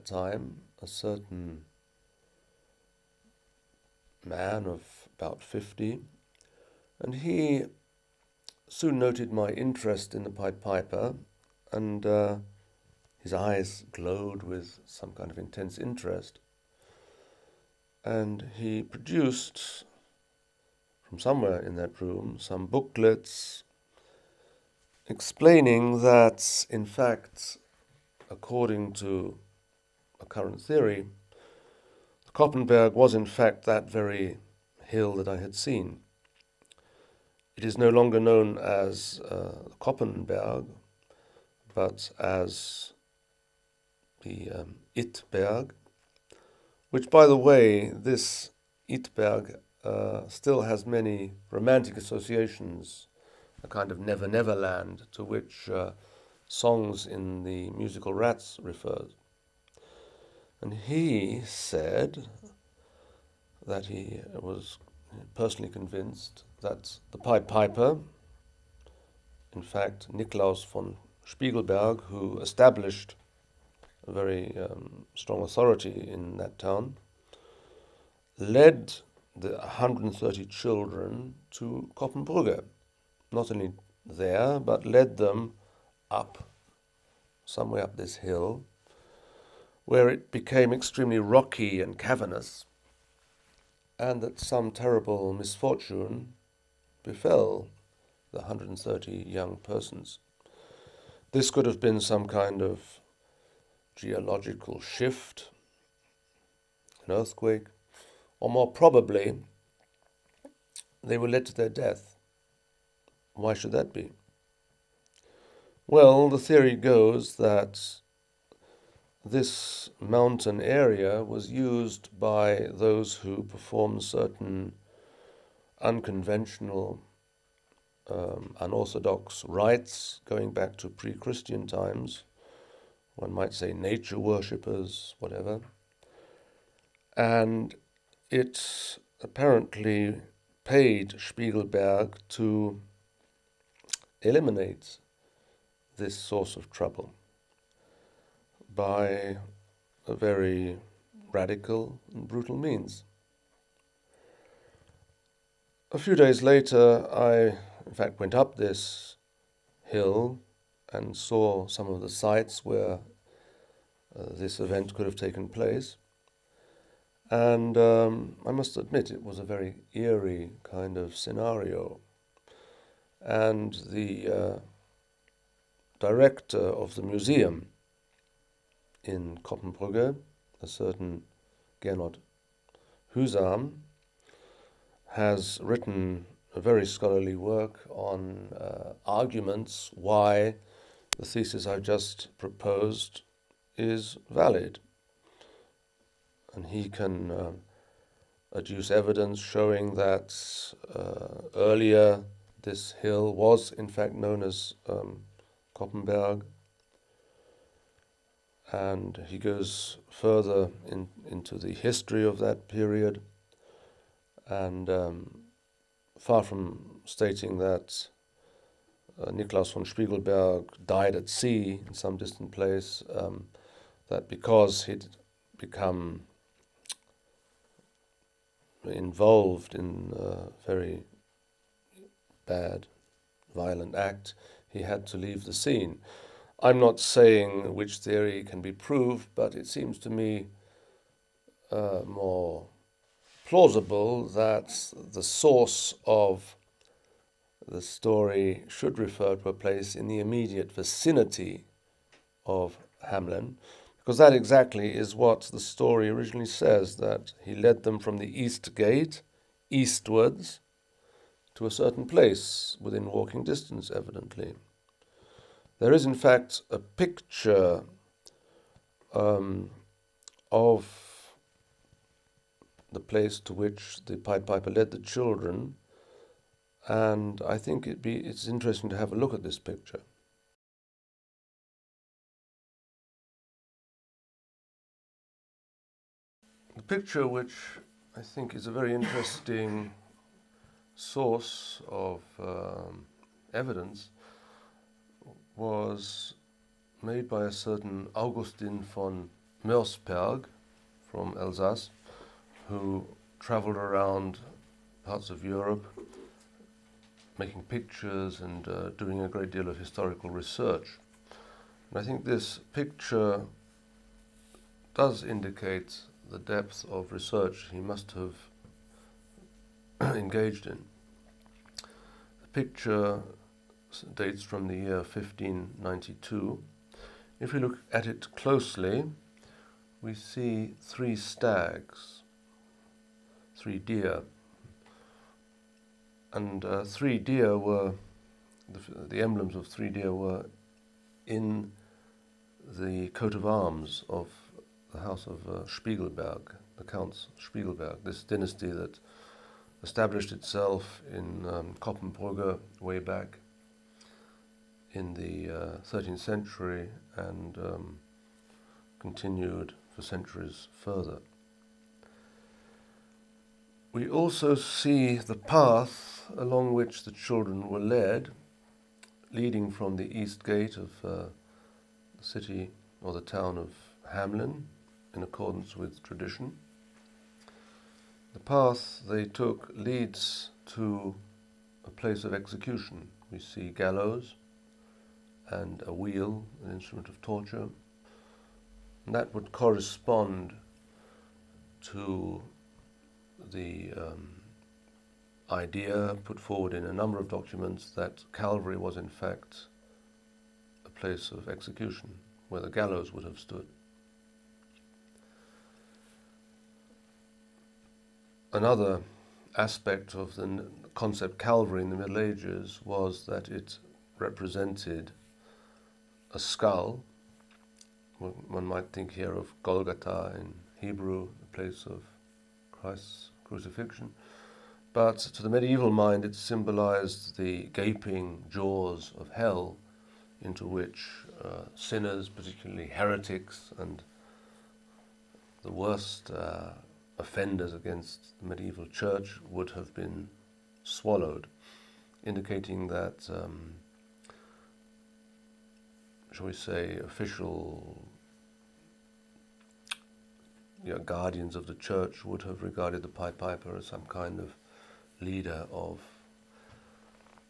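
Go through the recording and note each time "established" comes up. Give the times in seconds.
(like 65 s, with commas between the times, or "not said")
72 s, 349 s.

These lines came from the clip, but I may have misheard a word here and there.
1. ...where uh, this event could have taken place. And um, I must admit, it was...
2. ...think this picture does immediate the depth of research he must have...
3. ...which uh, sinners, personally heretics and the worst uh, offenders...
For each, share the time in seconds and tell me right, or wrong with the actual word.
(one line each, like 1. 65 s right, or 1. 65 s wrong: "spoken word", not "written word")
1. 162 s right
2. 312 s wrong: "indicate", not "immediate"
3. 430 s wrong: "particularly", not "personally".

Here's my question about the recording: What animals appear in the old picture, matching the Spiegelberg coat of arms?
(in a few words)
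three stags.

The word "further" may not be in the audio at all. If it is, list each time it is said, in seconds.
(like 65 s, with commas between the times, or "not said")
210 s, 360 s.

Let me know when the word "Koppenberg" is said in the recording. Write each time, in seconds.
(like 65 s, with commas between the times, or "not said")
32 s, 39 s, 205 s.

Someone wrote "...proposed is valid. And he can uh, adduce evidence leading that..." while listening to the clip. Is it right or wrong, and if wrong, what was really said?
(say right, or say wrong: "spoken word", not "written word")
wrong: "showing", not "leading".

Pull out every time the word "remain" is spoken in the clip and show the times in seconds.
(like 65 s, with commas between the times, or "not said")
not said.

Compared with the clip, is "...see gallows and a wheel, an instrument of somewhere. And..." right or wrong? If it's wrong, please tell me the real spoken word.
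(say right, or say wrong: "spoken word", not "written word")
wrong: "torture", not "somewhere".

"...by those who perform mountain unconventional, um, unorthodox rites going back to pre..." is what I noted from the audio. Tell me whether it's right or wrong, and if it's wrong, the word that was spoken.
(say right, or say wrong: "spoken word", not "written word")
wrong: "certain", not "mountain".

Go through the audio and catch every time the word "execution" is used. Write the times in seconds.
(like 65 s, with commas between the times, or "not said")
382 s, 401 s.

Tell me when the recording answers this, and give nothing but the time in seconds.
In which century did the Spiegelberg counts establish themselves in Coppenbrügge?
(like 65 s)
355 s.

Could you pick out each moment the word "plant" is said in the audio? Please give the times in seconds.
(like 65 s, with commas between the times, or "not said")
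not said.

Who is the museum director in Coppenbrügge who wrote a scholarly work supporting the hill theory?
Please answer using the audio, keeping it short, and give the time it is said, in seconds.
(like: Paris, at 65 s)
Gernot Husam, at 181 s.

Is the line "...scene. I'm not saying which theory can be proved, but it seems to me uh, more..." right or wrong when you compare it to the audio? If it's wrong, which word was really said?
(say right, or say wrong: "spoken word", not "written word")
right.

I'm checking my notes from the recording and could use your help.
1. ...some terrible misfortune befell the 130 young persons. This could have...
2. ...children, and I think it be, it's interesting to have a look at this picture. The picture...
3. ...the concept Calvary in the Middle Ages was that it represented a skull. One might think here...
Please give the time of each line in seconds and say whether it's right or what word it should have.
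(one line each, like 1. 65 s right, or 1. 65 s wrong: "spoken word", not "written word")
1. 94 s right
2. 274 s right
3. 410 s right.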